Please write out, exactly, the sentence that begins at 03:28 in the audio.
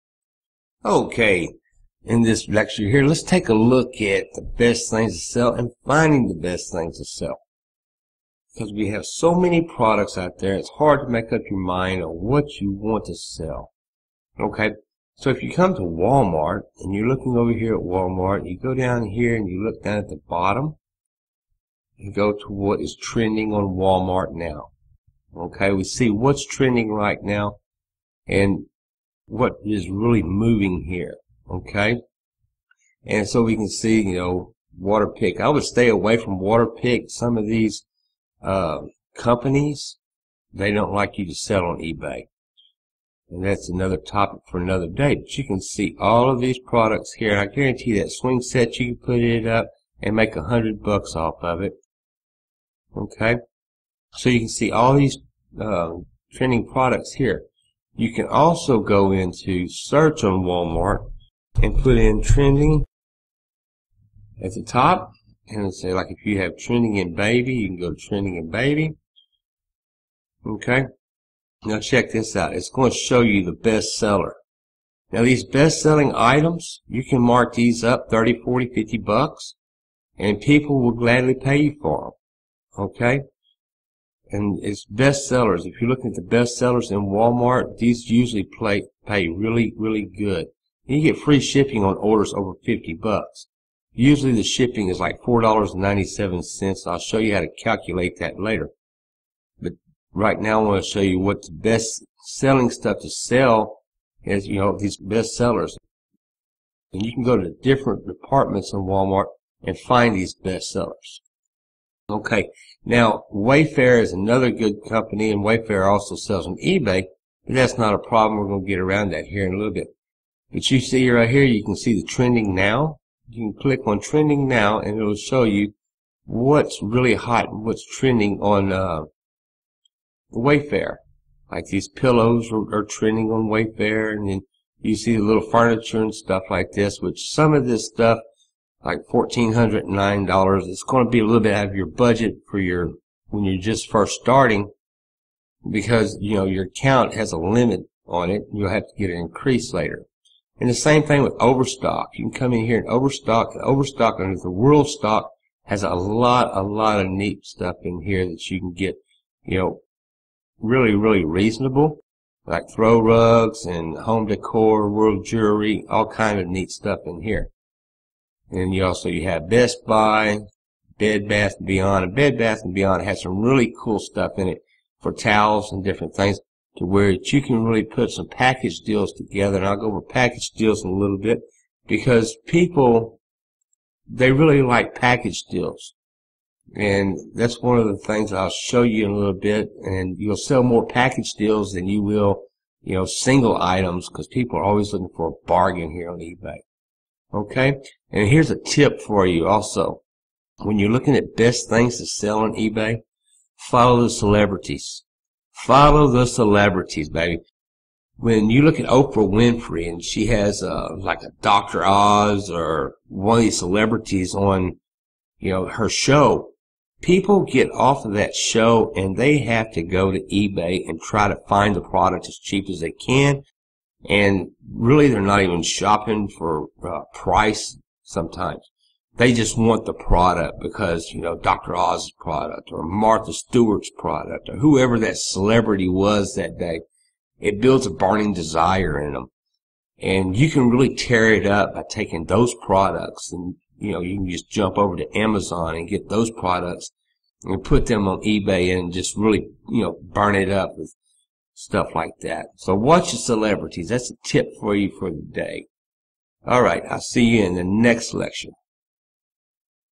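When you look at Oprah Winfrey and she has uh, like a Dr.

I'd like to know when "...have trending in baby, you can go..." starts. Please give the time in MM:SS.
01:06.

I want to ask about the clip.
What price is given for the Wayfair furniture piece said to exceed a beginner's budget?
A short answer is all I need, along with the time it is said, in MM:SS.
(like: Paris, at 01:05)
$1,409, at 02:19.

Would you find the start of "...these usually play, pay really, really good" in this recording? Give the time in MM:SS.
01:27.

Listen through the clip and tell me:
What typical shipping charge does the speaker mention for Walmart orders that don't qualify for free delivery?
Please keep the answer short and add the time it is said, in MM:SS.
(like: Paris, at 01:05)
$4.97, at 01:35.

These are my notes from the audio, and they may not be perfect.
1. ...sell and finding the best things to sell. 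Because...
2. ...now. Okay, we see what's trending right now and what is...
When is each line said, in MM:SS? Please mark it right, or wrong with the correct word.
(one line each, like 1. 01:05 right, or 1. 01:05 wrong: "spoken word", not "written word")
1. 00:05 right
2. 00:24 right.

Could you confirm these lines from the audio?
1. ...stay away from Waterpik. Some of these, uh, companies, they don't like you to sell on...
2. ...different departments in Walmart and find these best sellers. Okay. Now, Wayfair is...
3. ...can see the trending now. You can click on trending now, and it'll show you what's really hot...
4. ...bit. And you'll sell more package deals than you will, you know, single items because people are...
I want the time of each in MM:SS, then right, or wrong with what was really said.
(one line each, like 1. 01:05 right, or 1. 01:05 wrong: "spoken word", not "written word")
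1. 00:35 right
2. 01:47 right
3. 02:01 right
4. 03:09 right.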